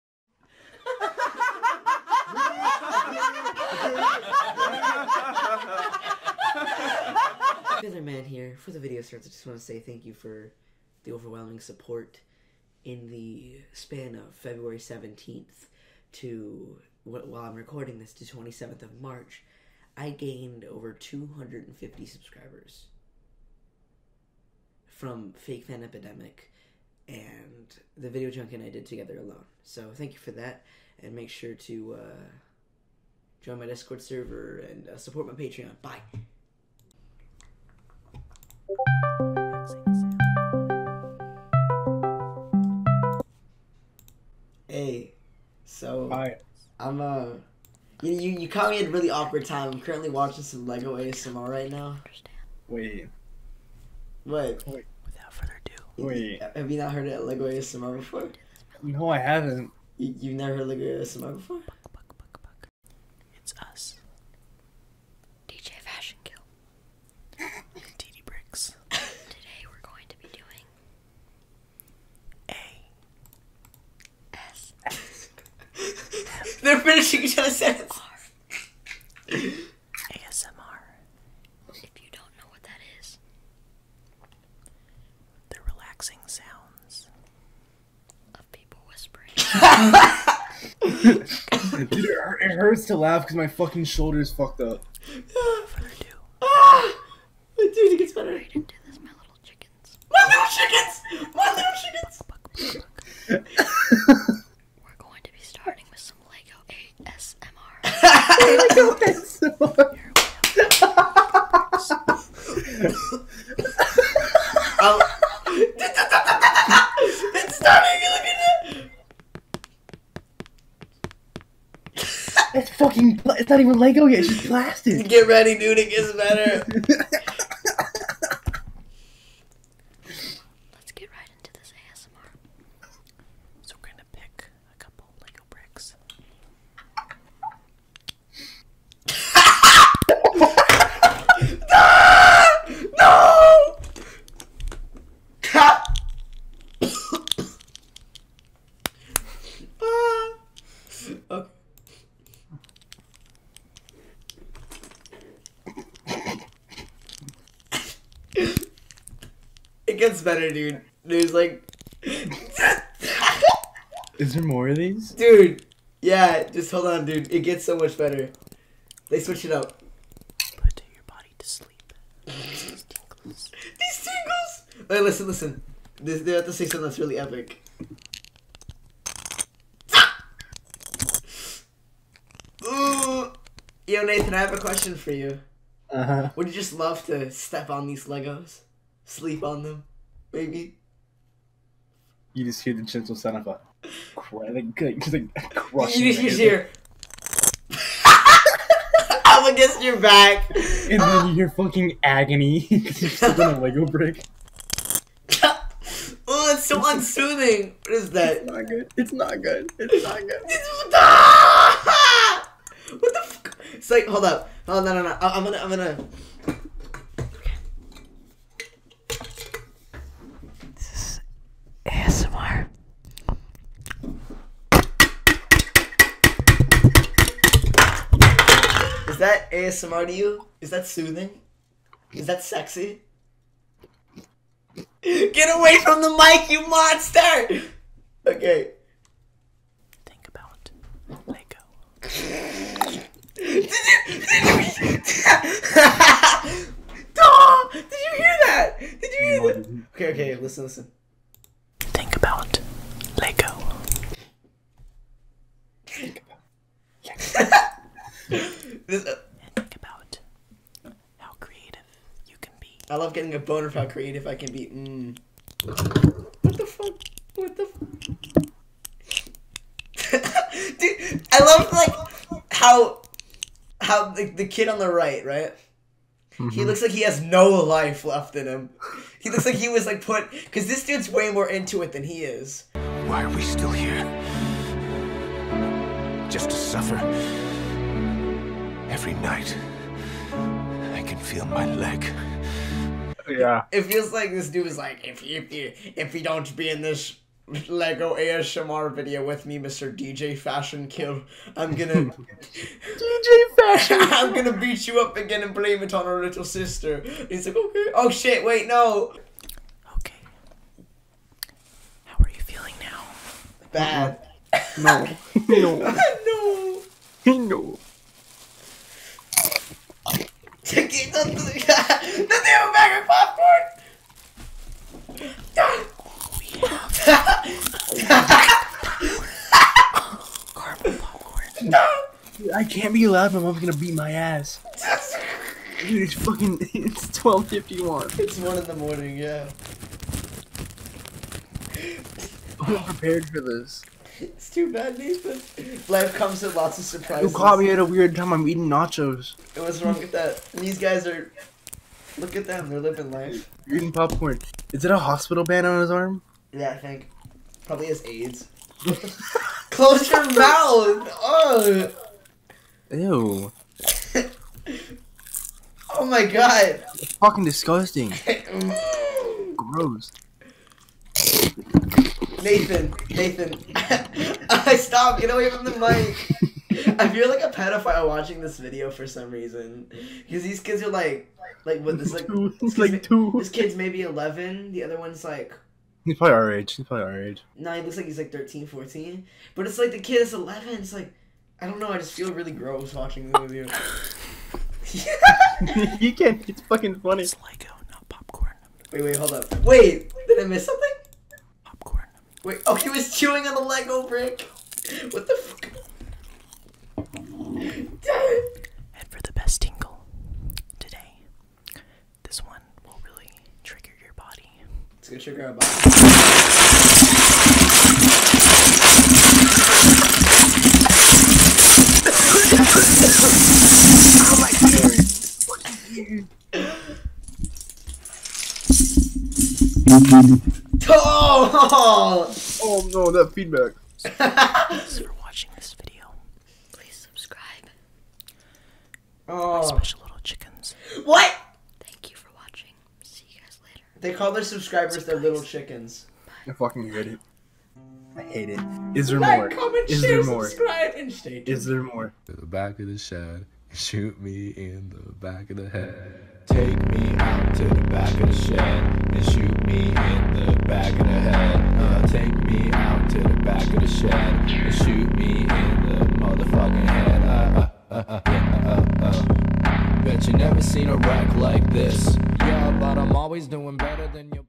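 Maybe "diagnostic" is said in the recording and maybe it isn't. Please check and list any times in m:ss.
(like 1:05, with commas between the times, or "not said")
not said.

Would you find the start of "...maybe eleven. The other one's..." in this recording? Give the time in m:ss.
6:23.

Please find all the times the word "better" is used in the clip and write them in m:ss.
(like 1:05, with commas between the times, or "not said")
1:38, 2:06, 2:40, 2:47, 7:53.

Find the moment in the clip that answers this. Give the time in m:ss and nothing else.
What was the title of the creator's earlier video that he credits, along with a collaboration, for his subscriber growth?
0:25.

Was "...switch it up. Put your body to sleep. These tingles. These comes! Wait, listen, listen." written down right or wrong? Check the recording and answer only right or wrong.
wrong.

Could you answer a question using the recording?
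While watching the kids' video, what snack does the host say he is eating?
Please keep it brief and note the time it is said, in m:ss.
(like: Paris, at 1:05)
Nachos, at 5:48.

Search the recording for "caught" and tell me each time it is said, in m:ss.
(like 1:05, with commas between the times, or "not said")
0:48, 5:47.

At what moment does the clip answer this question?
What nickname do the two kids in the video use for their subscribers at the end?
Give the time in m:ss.
7:19.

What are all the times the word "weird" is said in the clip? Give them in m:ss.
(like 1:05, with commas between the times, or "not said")
5:47.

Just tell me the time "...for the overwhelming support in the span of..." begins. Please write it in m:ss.
0:10.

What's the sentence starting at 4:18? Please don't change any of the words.
Uh, think about how creative you can be.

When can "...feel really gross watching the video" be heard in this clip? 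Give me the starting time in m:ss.
6:32.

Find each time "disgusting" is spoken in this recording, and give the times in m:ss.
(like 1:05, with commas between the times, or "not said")
6:07.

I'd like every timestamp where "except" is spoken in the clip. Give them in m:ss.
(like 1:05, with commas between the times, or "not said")
not said.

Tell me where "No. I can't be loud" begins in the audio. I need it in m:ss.
5:31.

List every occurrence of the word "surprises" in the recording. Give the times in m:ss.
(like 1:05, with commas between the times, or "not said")
5:46, 7:24.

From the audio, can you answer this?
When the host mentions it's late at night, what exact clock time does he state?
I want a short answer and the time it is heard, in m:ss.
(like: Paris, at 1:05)
12:51, at 5:37.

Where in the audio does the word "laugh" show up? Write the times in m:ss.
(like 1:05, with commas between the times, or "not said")
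1:32.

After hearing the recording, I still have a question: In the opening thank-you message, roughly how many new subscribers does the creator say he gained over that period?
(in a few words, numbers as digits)
over 250.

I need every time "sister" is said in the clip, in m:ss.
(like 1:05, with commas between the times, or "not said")
5:06.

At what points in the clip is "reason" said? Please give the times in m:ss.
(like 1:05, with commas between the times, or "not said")
6:19.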